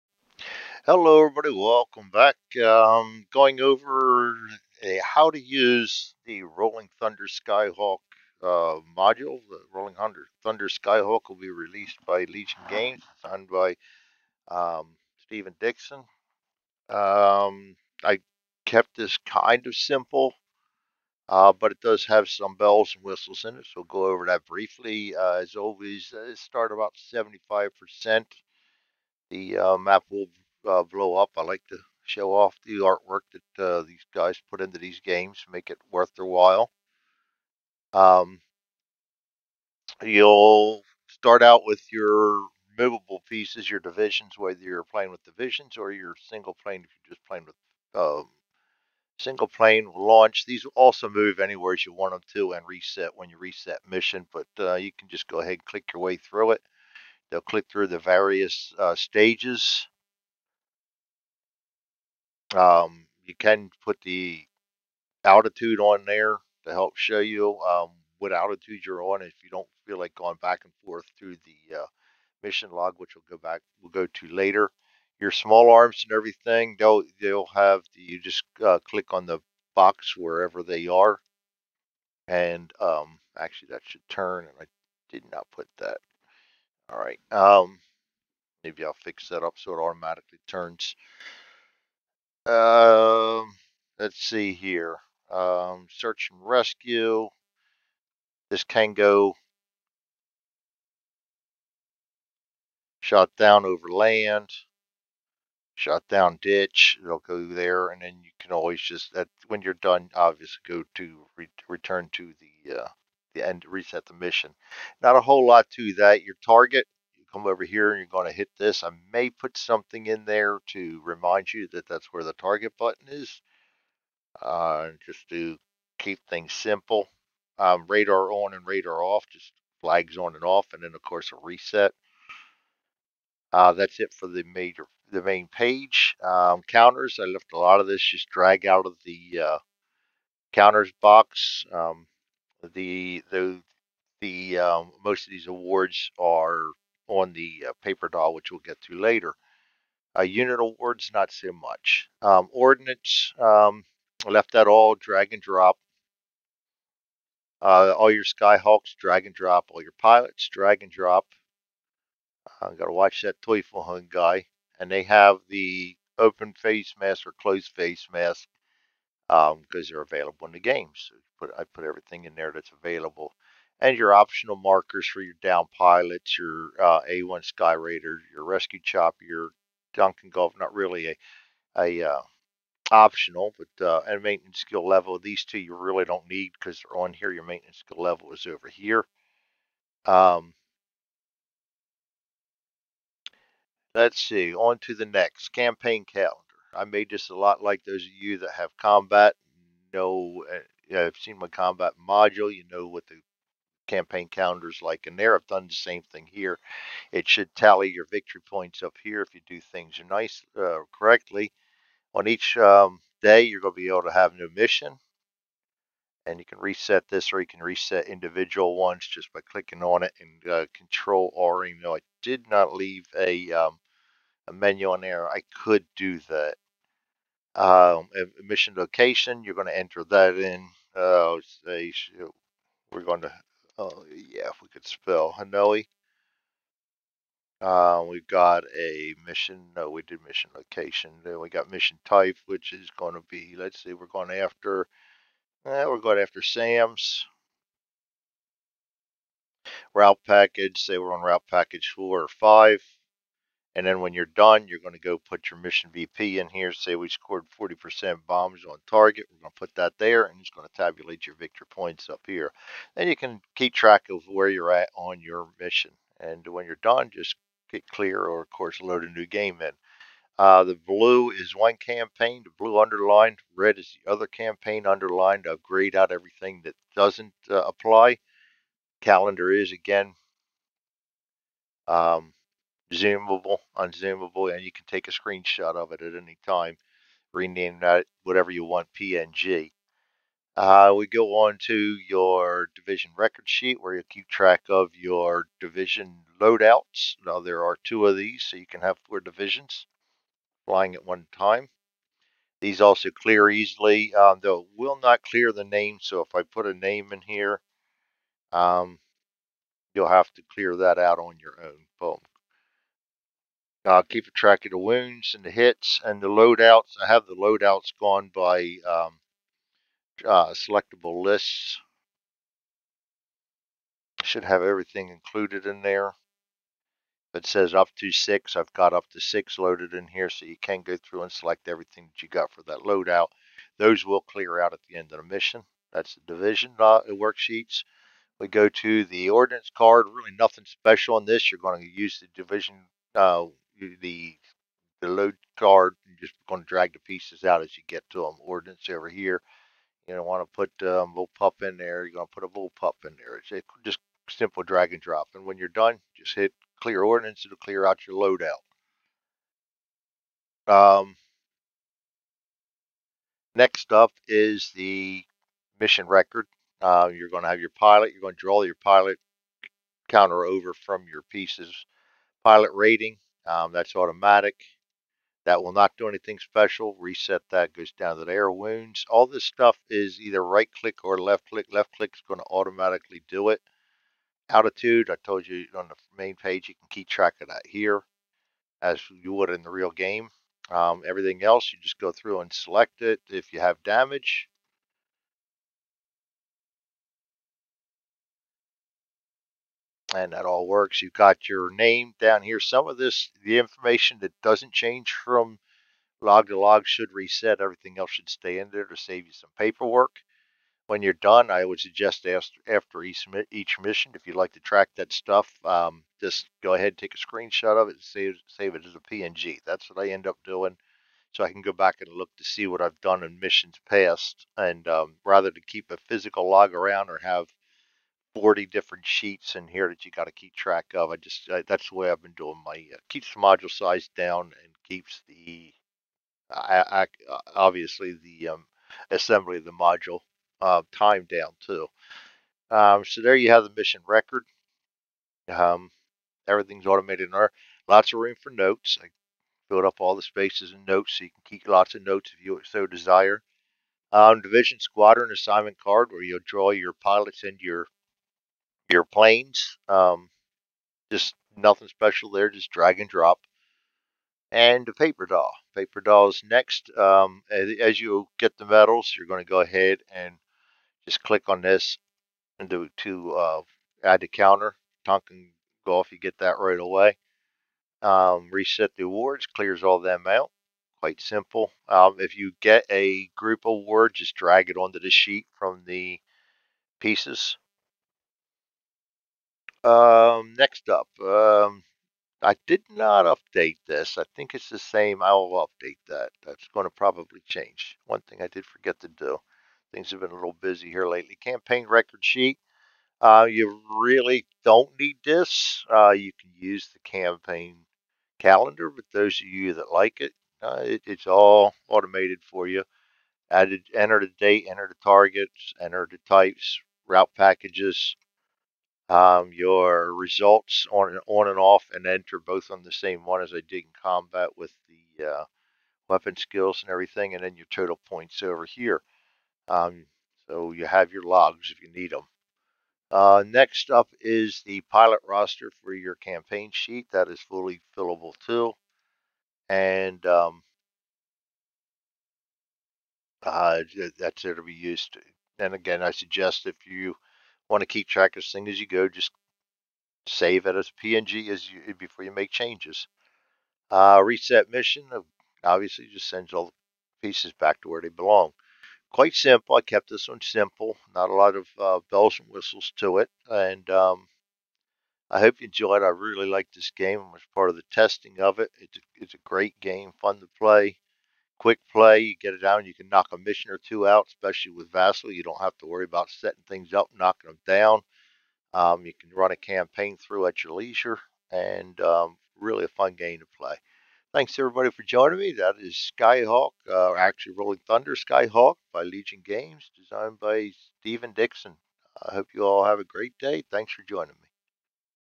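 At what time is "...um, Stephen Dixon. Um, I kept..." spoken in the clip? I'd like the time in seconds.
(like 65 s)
14 s.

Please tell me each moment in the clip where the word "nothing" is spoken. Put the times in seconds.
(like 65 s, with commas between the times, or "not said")
340 s, 461 s.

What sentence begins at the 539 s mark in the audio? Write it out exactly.
And um, uh, that's there to be used.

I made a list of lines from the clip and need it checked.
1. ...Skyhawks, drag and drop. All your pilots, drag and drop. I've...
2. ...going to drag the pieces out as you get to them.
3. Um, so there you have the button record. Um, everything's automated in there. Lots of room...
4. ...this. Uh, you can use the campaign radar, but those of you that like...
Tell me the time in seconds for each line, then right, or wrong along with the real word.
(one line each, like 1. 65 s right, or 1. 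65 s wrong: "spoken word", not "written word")
1. 158 s right
2. 346 s right
3. 442 s wrong: "mission", not "button"
4. 505 s wrong: "calendar", not "radar".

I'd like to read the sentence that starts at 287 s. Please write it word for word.
Rename that whatever you want, PNG.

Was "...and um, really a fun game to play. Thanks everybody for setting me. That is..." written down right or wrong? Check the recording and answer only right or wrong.
wrong.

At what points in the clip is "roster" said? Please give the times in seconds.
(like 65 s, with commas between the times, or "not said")
535 s.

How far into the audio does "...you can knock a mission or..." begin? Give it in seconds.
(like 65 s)
572 s.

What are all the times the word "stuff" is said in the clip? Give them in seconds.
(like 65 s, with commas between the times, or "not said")
379 s, 415 s.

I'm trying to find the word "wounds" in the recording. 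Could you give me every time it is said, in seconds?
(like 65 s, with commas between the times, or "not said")
314 s, 378 s.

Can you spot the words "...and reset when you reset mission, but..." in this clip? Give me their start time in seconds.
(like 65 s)
52 s.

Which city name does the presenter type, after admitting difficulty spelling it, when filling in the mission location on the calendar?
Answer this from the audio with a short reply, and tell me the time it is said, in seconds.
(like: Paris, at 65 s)
Hanoi, at 235 s.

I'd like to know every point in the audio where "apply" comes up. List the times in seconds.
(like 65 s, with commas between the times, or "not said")
277 s.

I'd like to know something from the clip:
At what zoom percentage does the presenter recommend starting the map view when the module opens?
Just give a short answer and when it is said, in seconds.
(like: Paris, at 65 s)
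75%, at 27 s.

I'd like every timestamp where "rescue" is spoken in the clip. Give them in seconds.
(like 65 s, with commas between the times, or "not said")
96 s, 178 s.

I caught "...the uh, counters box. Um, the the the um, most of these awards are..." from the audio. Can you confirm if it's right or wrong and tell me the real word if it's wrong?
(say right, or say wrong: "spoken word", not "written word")
right.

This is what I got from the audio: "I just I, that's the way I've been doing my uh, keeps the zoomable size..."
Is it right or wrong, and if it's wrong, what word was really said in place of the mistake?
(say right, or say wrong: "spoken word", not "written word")
wrong: "module", not "zoomable".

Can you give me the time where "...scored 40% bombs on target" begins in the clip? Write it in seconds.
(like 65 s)
257 s.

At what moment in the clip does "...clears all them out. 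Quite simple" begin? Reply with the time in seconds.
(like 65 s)
479 s.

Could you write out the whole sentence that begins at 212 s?
On each um, day, you're going to be able to have a new mission.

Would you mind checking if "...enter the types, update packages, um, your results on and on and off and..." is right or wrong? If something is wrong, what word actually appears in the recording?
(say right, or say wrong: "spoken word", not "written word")
wrong: "route", not "update".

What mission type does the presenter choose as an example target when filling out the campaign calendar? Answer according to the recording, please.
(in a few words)
SAMs.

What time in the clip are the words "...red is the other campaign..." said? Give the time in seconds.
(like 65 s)
273 s.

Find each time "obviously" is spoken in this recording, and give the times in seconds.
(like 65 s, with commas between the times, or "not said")
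110 s, 437 s, 555 s.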